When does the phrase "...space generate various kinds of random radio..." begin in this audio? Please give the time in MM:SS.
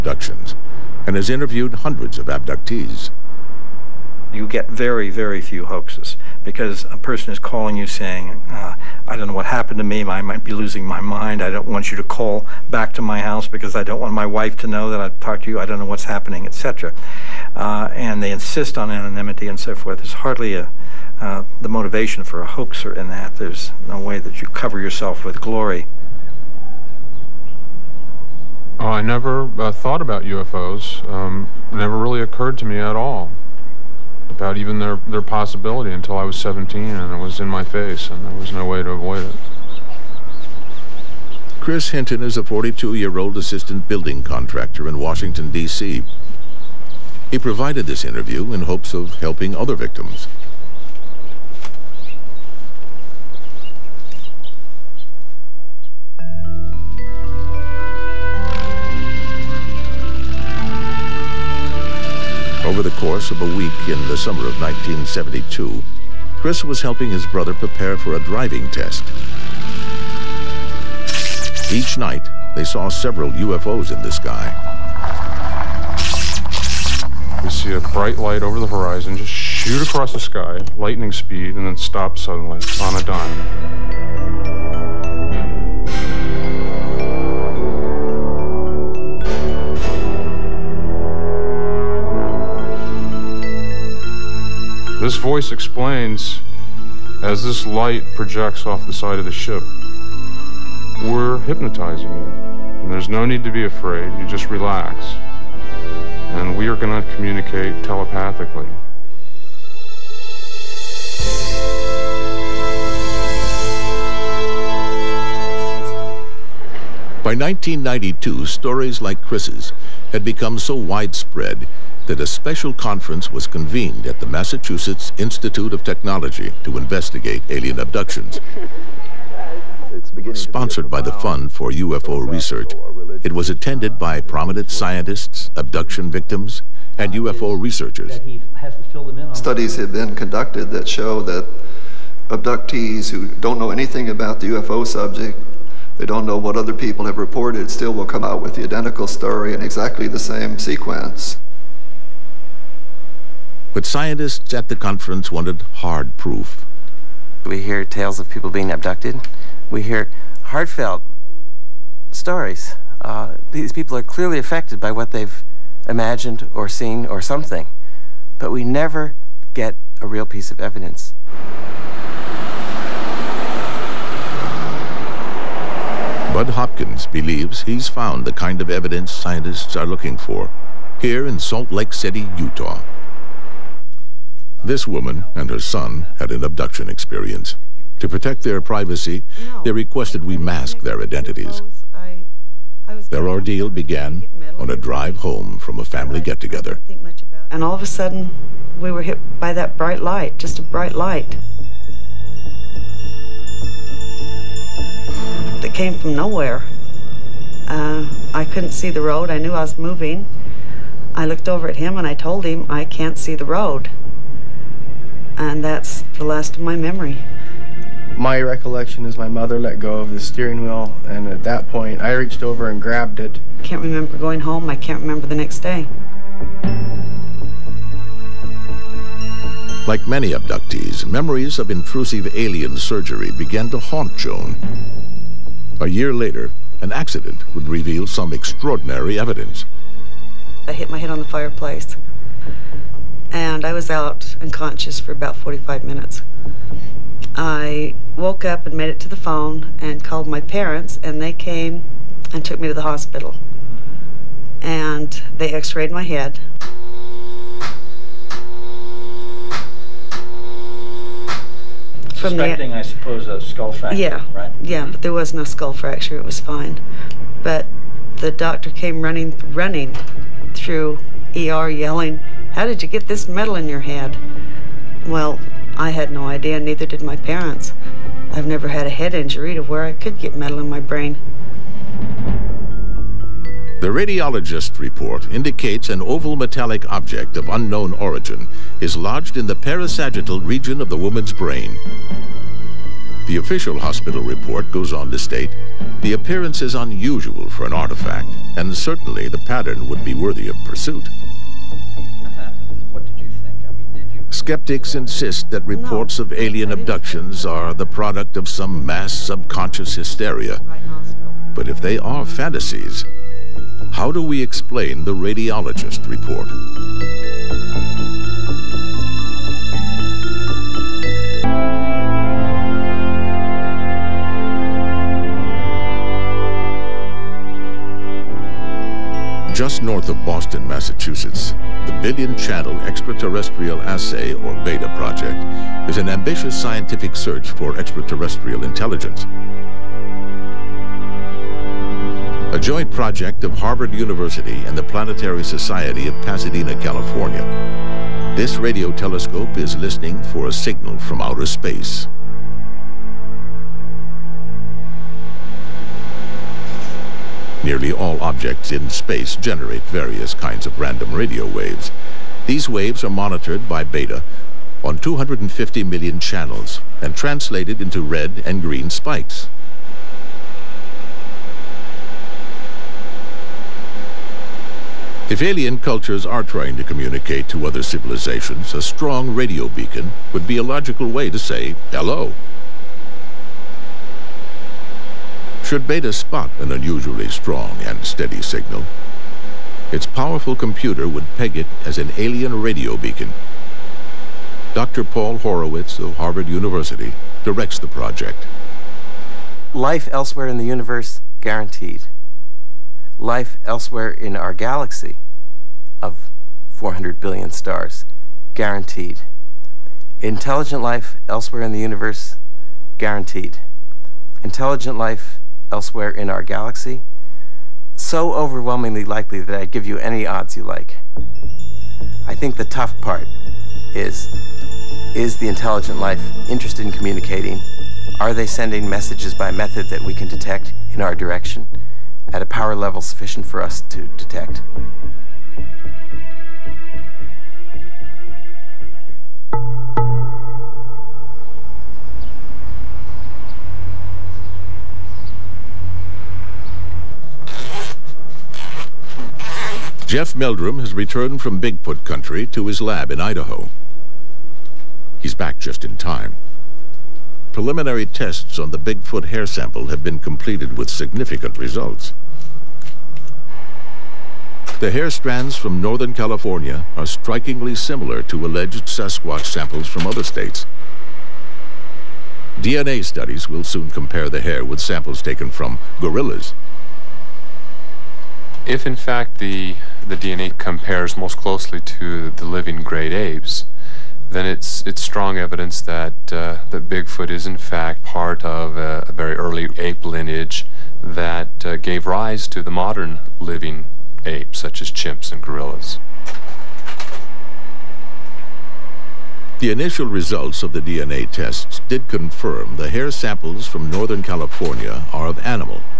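05:58.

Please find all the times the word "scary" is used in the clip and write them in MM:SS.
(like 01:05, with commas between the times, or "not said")
not said.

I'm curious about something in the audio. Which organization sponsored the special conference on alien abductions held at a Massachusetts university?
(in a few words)
Fund for UFO Research.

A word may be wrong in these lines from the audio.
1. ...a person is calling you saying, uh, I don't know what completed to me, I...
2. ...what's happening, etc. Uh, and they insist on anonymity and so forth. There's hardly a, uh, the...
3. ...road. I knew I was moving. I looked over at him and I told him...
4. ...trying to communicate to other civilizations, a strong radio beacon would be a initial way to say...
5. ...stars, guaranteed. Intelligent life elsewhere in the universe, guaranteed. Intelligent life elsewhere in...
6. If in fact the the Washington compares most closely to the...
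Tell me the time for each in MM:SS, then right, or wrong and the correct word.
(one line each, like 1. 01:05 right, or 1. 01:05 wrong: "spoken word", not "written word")
1. 00:06 wrong: "happened", not "completed"
2. 00:15 right
3. 03:29 right
4. 06:16 wrong: "logical", not "initial"
5. 06:47 right
6. 07:58 wrong: "DNA", not "Washington".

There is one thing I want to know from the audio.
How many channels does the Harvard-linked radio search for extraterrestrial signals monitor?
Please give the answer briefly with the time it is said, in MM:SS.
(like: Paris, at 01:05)
250 million, at 06:04.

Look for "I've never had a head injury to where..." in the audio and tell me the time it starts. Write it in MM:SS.
04:38.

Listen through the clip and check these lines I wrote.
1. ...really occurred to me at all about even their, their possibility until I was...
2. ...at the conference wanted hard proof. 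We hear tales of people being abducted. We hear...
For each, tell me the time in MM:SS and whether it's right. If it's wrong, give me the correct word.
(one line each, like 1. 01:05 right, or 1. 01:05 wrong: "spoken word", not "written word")
1. 00:31 right
2. 02:34 right.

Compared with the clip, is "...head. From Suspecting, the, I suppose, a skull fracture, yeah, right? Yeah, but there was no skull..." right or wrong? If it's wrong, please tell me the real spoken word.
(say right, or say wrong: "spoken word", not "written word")
right.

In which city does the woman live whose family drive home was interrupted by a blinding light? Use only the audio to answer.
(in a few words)
Salt Lake City.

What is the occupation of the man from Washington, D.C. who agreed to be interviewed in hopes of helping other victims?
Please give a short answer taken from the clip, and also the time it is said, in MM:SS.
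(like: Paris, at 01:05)
Assistant building contractor, at 00:43.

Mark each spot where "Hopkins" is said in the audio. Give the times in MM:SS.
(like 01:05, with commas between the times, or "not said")
02:56.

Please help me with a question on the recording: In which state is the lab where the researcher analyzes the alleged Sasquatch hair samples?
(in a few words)
Idaho.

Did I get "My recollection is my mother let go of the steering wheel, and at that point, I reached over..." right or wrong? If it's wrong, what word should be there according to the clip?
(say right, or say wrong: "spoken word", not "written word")
right.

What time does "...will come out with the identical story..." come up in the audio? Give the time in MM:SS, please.
02:27.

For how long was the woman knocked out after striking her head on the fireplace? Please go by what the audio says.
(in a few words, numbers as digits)
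About 45 minutes.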